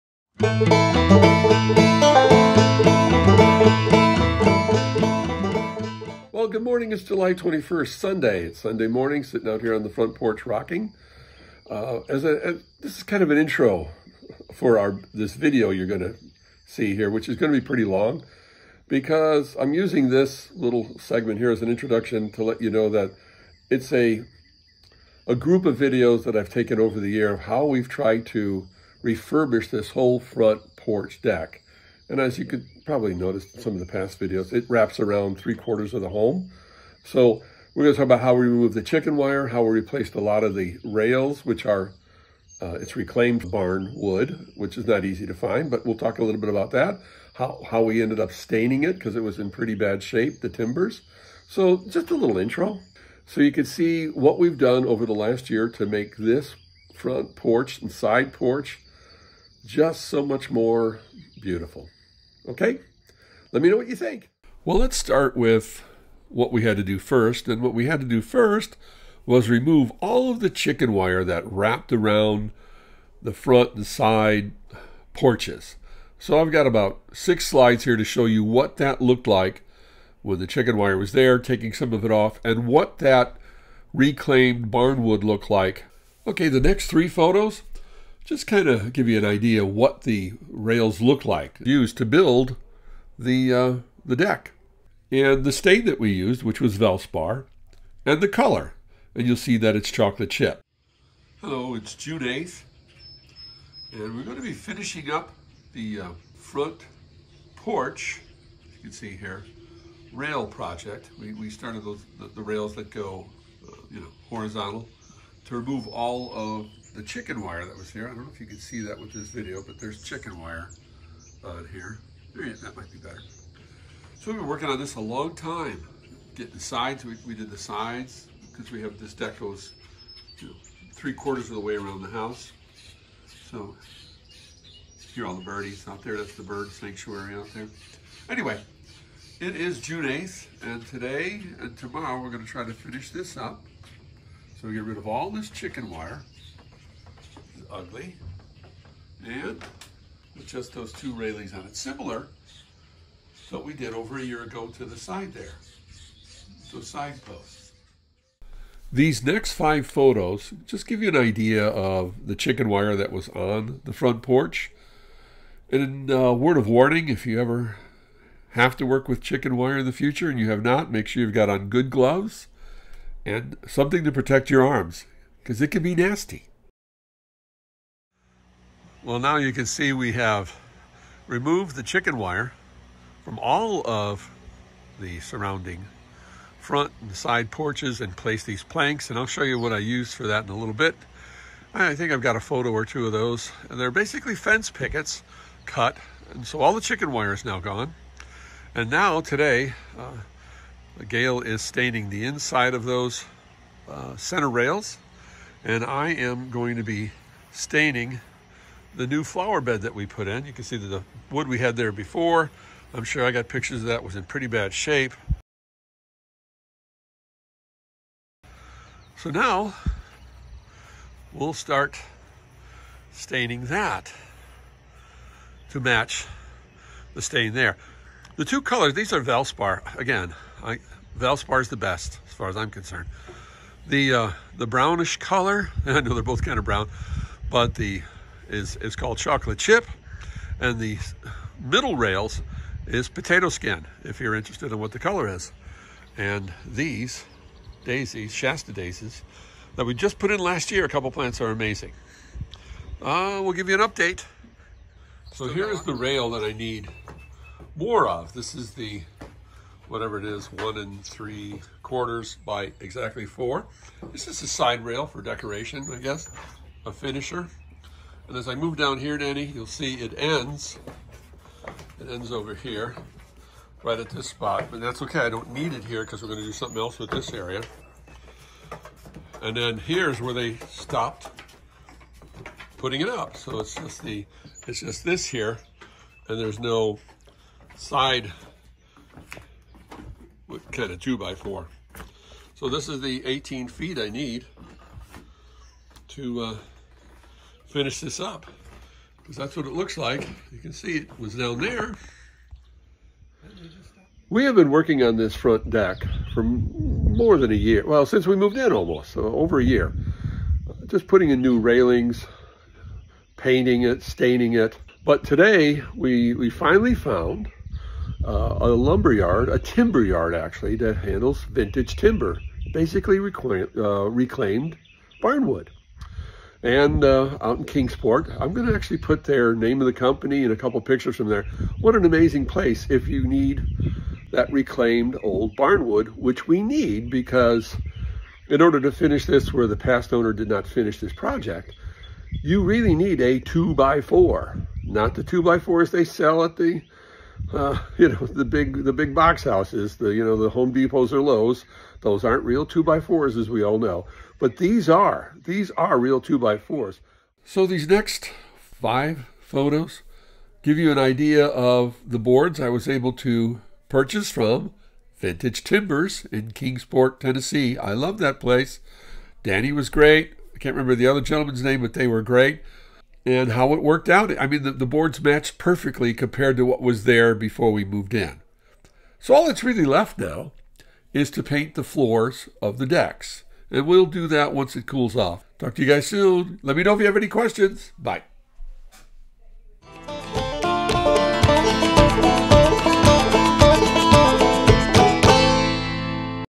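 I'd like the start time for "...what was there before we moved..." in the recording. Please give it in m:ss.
6:16.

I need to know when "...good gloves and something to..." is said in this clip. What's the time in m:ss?
2:51.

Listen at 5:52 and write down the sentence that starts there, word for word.
Those aren't real two by fours, as we all know, but these are these are real two by fours.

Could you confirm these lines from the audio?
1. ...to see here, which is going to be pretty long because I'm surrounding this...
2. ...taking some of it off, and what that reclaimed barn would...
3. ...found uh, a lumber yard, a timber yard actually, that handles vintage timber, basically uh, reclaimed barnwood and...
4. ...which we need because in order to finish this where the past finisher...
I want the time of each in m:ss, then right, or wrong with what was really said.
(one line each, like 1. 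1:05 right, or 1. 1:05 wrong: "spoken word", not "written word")
1. 0:16 wrong: "using", not "surrounding"
2. 1:21 right
3. 5:16 right
4. 5:36 wrong: "owner", not "finisher".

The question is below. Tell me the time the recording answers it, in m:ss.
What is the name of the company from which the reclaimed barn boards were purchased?
6:05.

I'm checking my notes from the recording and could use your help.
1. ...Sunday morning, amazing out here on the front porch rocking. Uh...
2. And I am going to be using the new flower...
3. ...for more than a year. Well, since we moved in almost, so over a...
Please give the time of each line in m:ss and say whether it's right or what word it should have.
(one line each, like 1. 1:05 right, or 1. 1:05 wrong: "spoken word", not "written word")
1. 0:08 wrong: "sitting", not "amazing"
2. 3:25 wrong: "staining", not "using"
3. 5:06 right.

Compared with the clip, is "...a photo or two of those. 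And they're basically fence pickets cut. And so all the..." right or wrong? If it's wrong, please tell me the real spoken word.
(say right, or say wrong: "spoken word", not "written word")
right.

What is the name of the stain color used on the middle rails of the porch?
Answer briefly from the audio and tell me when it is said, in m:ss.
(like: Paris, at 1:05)
potato skin, at 4:03.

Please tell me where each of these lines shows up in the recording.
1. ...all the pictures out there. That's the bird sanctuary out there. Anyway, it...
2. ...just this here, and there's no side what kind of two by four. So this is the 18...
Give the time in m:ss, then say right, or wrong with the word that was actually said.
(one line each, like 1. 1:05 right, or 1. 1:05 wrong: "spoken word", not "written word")
1. 2:15 wrong: "birdies", not "pictures"
2. 4:44 right.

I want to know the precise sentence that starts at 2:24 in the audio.
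So we get rid of all this chicken wire ugly.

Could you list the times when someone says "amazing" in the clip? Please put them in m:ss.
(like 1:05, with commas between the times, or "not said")
4:11, 5:32.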